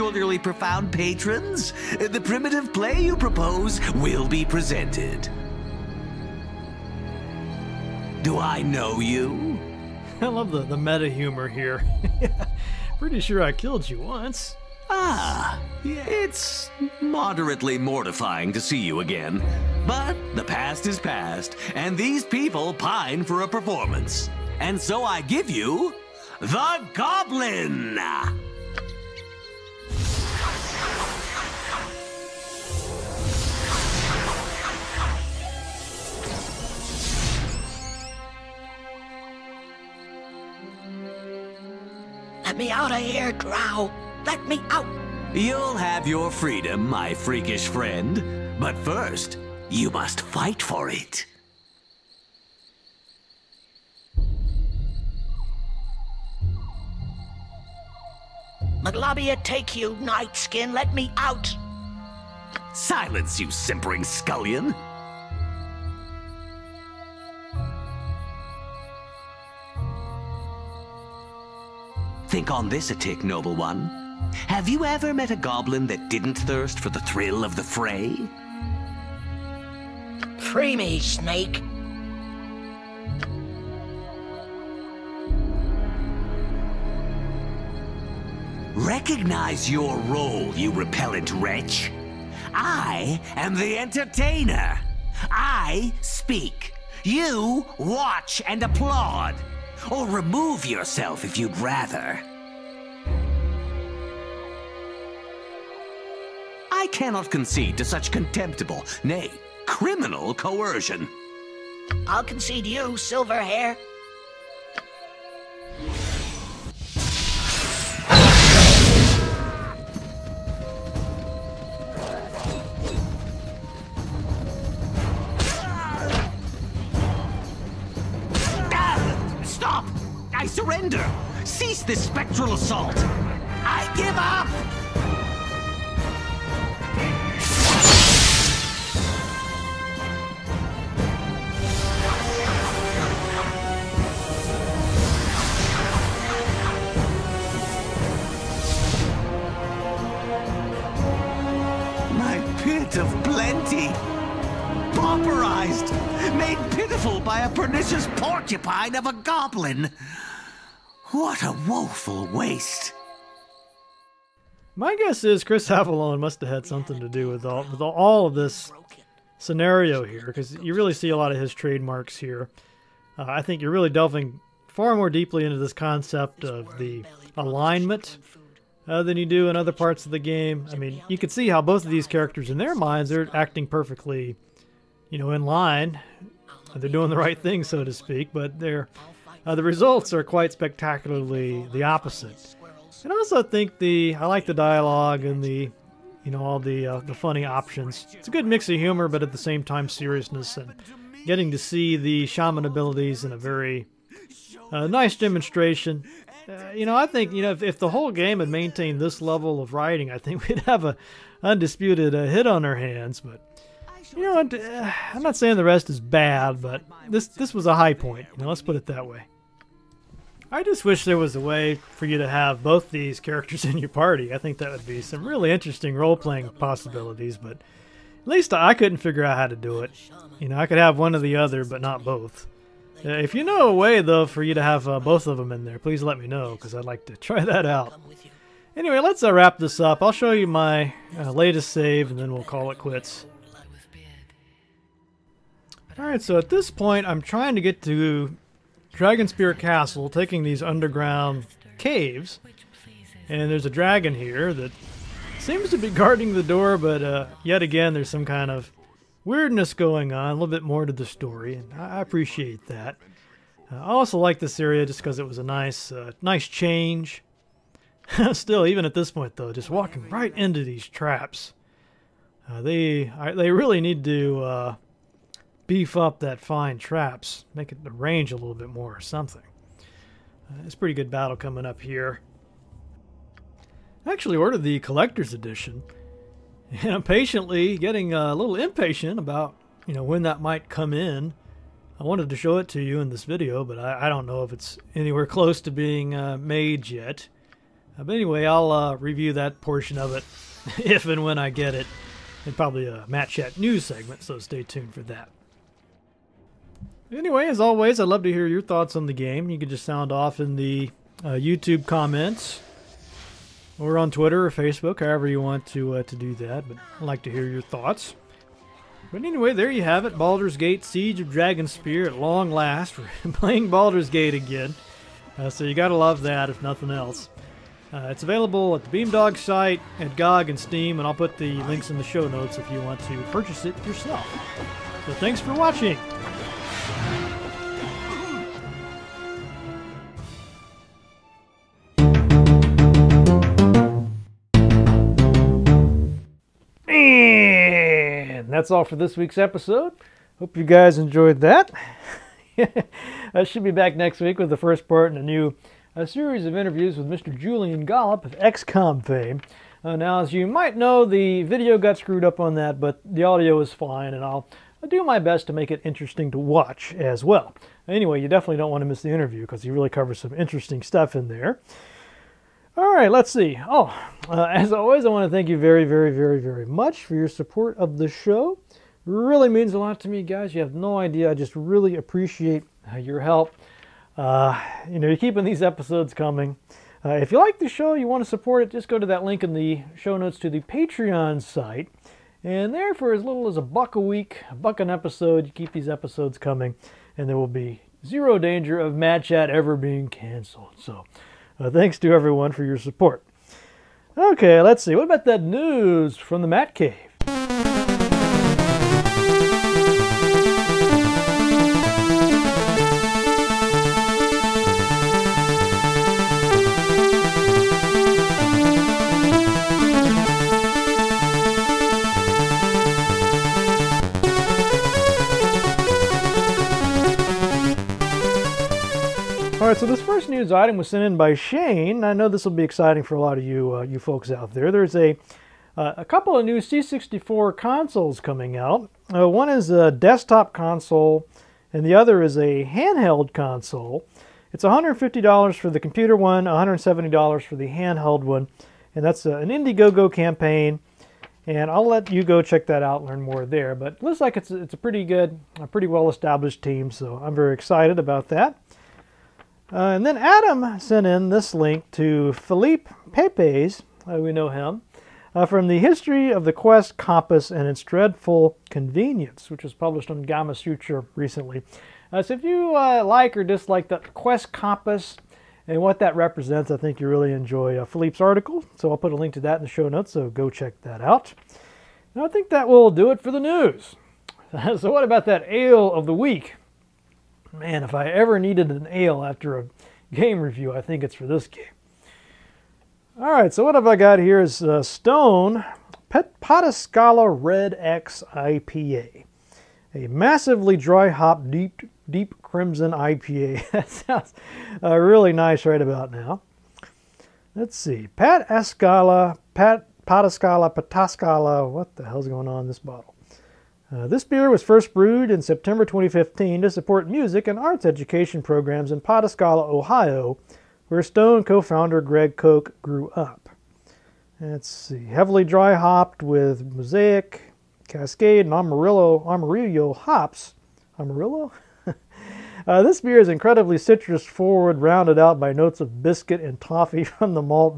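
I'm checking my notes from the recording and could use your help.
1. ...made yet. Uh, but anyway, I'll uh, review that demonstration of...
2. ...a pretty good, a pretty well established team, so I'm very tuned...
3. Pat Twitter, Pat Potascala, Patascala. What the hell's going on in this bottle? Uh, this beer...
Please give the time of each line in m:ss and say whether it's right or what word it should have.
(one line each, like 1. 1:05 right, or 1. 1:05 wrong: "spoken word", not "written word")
1. 4:56 wrong: "portion", not "demonstration"
2. 7:34 wrong: "excited", not "tuned"
3. 8:28 wrong: "Ascala", not "Twitter".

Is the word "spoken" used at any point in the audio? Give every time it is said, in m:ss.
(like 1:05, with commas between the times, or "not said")
not said.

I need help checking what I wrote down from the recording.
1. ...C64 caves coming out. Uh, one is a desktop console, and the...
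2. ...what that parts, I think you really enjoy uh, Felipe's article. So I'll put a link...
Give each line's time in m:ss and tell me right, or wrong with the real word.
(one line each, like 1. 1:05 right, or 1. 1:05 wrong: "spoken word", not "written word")
1. 7:16 wrong: "consoles", not "caves"
2. 7:55 wrong: "represents", not "parts".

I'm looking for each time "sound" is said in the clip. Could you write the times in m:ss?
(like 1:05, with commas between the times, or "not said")
5:09, 8:23.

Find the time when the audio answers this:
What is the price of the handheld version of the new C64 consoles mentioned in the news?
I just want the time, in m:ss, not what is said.
7:26.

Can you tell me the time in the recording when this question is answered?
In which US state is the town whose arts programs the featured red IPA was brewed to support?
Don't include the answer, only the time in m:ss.
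8:39.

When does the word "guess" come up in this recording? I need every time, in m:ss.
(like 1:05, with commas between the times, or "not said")
2:44.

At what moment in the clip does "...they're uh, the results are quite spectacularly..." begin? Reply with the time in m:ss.
3:08.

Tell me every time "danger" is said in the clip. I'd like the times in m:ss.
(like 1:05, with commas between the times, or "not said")
6:38.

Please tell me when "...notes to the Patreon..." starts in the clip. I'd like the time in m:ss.
6:30.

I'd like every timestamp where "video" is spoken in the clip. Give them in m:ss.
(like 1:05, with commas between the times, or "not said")
4:53, 6:01.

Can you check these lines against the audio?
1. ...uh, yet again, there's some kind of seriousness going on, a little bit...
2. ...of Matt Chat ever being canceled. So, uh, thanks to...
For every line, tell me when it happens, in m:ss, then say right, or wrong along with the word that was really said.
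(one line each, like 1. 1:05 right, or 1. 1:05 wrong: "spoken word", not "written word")
1. 4:17 wrong: "weirdness", not "seriousness"
2. 6:38 right.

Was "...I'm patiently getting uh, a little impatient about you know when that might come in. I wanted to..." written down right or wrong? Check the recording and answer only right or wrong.
right.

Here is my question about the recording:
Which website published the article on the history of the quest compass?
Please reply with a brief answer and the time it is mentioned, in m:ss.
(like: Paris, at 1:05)
Gamasutra, at 7:50.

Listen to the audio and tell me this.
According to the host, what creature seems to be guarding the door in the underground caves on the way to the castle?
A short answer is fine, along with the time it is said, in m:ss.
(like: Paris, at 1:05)
A dragon, at 4:13.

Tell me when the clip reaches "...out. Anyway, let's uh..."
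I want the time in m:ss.
3:57.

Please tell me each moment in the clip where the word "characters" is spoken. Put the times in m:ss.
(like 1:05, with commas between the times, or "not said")
3:02, 3:43.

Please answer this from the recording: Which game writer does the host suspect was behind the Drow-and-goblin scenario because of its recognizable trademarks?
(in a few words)
Chris Avellone.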